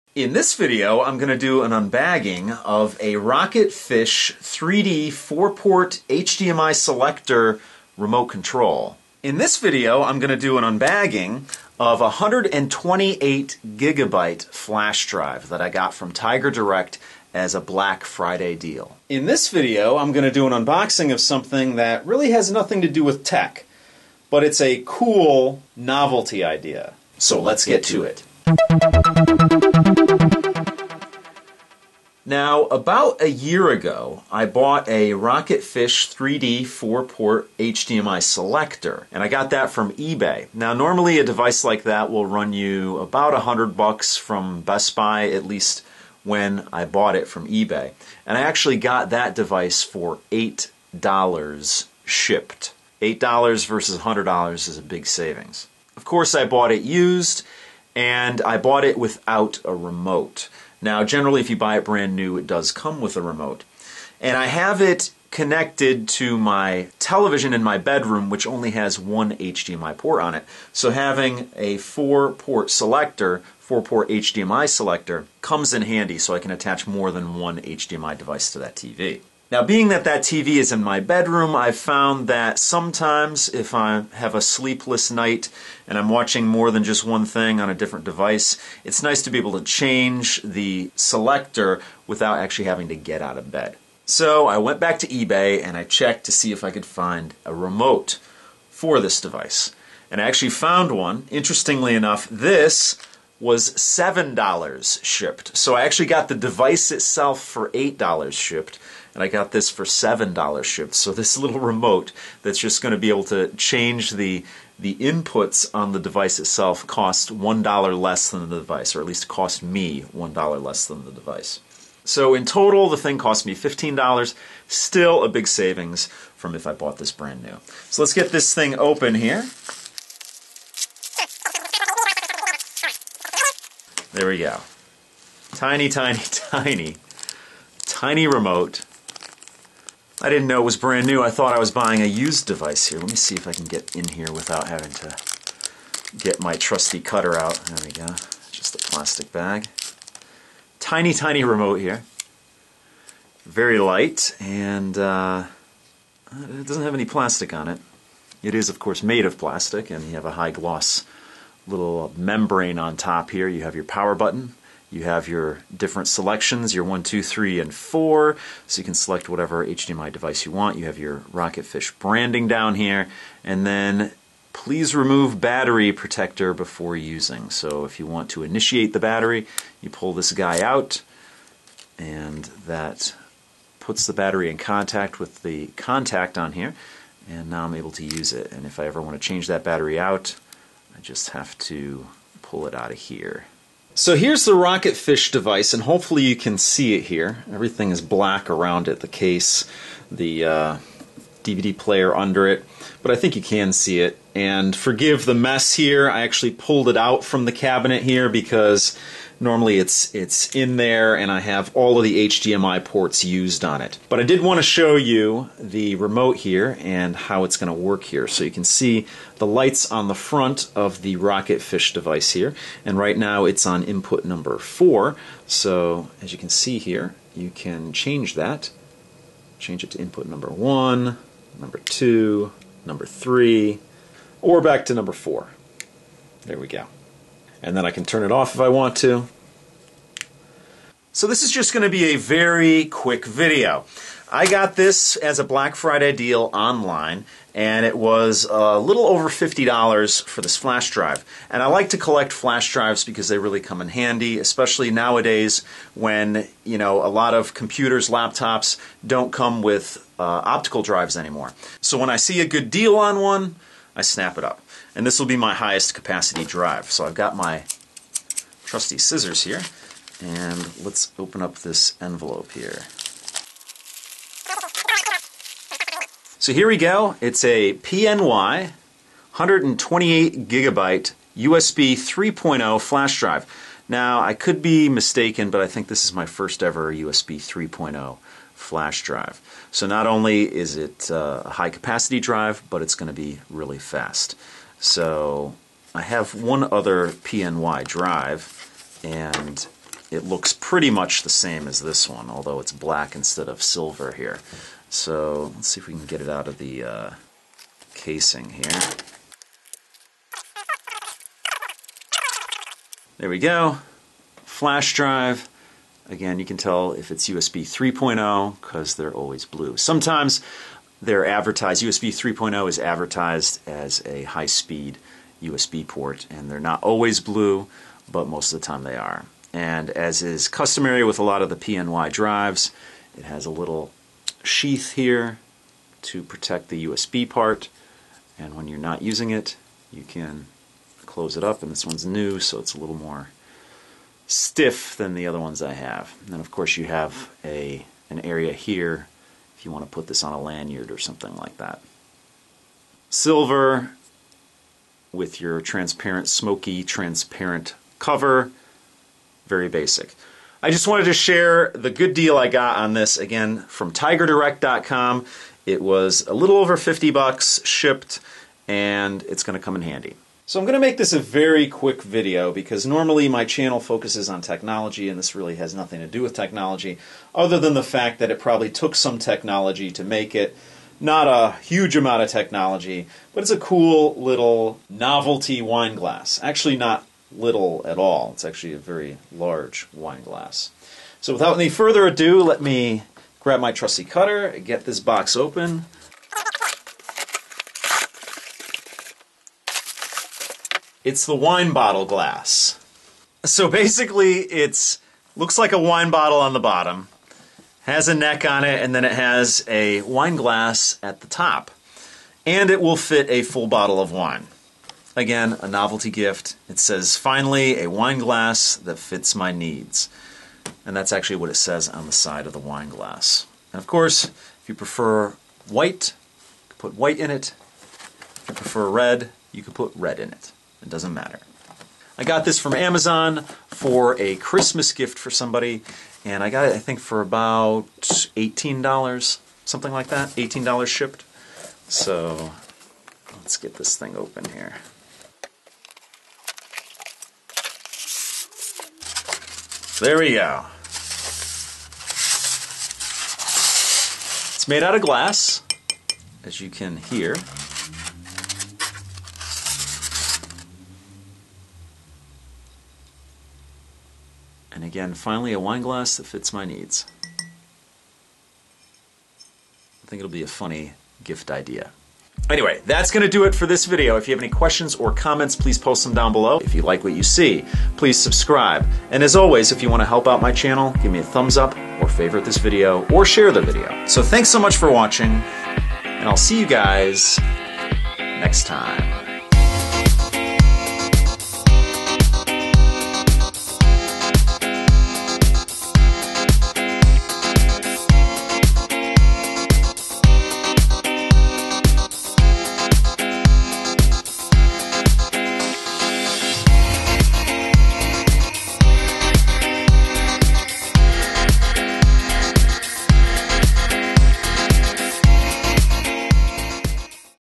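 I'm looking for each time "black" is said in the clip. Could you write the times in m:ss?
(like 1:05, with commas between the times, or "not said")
0:17, 3:17, 4:05, 5:02.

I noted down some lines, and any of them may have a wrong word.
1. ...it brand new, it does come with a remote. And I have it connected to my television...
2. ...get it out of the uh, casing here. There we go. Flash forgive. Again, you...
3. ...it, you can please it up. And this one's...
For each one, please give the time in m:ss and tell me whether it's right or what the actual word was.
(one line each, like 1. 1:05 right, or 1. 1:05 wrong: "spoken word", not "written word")
1. 1:01 right
2. 5:06 wrong: "drive", not "forgive"
3. 5:39 wrong: "close", not "please".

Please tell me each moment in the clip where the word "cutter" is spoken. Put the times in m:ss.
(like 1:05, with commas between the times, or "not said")
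2:26, 6:34.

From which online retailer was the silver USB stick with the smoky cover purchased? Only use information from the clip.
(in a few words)
tigerdirect.com.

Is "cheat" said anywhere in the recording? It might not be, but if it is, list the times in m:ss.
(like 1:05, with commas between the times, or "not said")
not said.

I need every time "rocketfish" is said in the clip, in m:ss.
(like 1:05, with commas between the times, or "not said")
0:03, 0:35, 2:51, 3:14, 3:41.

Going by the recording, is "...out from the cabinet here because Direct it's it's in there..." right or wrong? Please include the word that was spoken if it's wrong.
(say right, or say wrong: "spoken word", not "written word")
wrong: "Normally", not "Direct".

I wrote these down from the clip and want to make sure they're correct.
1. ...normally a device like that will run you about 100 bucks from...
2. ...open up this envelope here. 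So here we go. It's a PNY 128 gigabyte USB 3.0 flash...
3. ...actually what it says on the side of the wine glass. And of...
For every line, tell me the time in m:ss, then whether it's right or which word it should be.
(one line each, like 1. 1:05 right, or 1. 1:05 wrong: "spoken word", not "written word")
1. 0:40 right
2. 4:31 right
3. 7:01 right.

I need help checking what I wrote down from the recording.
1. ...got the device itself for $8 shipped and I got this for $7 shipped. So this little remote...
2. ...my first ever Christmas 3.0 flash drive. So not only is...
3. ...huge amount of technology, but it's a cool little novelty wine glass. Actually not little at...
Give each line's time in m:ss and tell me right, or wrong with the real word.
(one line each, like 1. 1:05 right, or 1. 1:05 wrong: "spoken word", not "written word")
1. 1:46 right
2. 4:46 wrong: "USB", not "Christmas"
3. 6:21 right.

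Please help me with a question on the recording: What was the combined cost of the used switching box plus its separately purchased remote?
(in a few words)
$15.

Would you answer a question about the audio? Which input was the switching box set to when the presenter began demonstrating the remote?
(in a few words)
4.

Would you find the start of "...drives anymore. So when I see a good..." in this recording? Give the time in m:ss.
4:20.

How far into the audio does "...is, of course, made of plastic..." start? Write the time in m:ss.
2:38.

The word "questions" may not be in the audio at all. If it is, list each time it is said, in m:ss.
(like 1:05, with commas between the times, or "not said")
7:54.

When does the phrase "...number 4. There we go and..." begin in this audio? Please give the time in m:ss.
3:54.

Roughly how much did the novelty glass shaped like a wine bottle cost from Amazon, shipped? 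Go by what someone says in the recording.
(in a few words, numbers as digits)
$18.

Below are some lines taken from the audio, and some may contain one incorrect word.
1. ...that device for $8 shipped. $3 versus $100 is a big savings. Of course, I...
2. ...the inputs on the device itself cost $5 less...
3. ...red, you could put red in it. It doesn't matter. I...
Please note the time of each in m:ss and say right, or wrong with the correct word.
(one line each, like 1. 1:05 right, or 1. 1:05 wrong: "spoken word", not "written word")
1. 0:49 wrong: "8", not "3"
2. 1:54 wrong: "1", not "5"
3. 7:08 right.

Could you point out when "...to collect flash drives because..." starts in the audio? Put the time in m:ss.
4:11.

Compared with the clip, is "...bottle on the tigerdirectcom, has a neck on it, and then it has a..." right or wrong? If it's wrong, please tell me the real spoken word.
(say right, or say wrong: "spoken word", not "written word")
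wrong: "bottom", not "tigerdirectcom".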